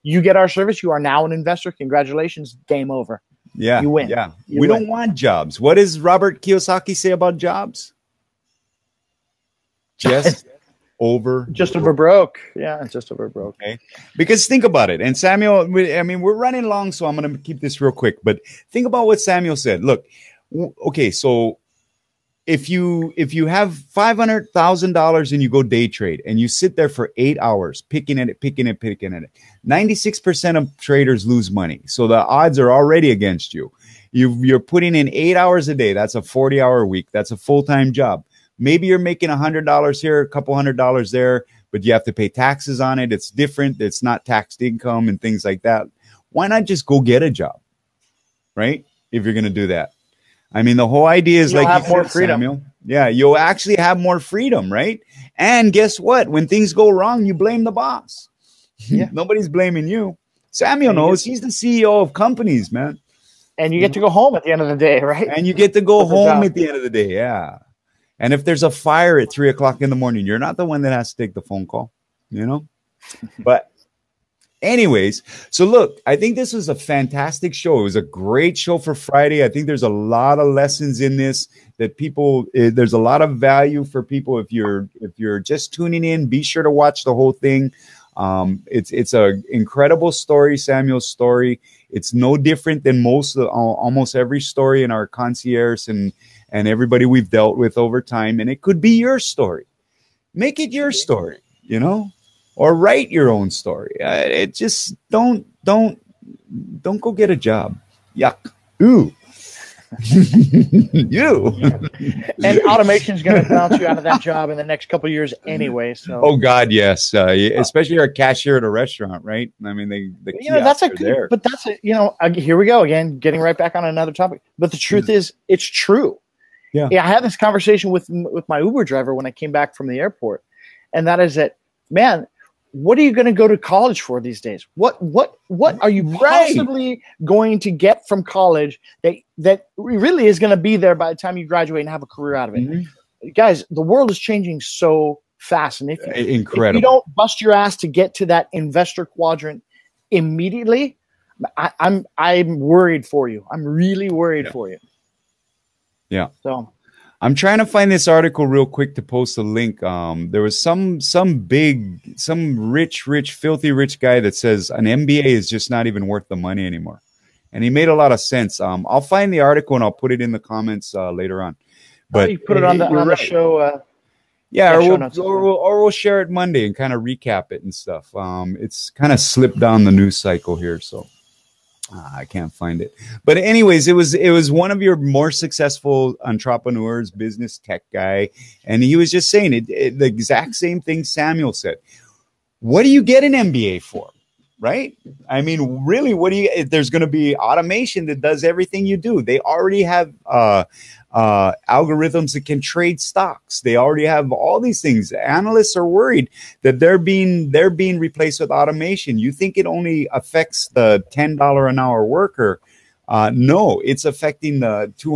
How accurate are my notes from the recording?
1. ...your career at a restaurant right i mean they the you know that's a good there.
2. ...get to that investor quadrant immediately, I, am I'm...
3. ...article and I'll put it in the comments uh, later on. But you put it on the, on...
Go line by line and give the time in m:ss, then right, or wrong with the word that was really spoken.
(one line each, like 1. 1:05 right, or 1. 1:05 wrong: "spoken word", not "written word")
1. 1:57 wrong: "cashier", not "career"
2. 2:27 right
3. 2:49 right.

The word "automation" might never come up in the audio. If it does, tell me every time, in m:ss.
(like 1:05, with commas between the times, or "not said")
1:52, 3:17, 3:28.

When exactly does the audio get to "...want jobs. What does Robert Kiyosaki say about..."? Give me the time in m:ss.
0:04.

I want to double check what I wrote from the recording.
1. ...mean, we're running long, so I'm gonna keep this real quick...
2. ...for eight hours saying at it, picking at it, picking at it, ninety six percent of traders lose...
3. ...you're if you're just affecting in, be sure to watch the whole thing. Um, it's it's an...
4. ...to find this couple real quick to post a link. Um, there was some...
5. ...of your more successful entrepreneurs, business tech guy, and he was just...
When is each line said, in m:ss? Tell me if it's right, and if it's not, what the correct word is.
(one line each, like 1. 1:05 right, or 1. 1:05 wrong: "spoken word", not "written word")
1. 0:16 right
2. 0:26 wrong: "picking", not "saying"
3. 1:24 wrong: "tuning", not "affecting"
4. 2:37 wrong: "article", not "couple"
5. 3:04 right.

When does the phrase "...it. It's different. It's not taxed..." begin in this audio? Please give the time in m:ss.
0:42.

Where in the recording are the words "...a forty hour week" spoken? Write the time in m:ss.
0:36.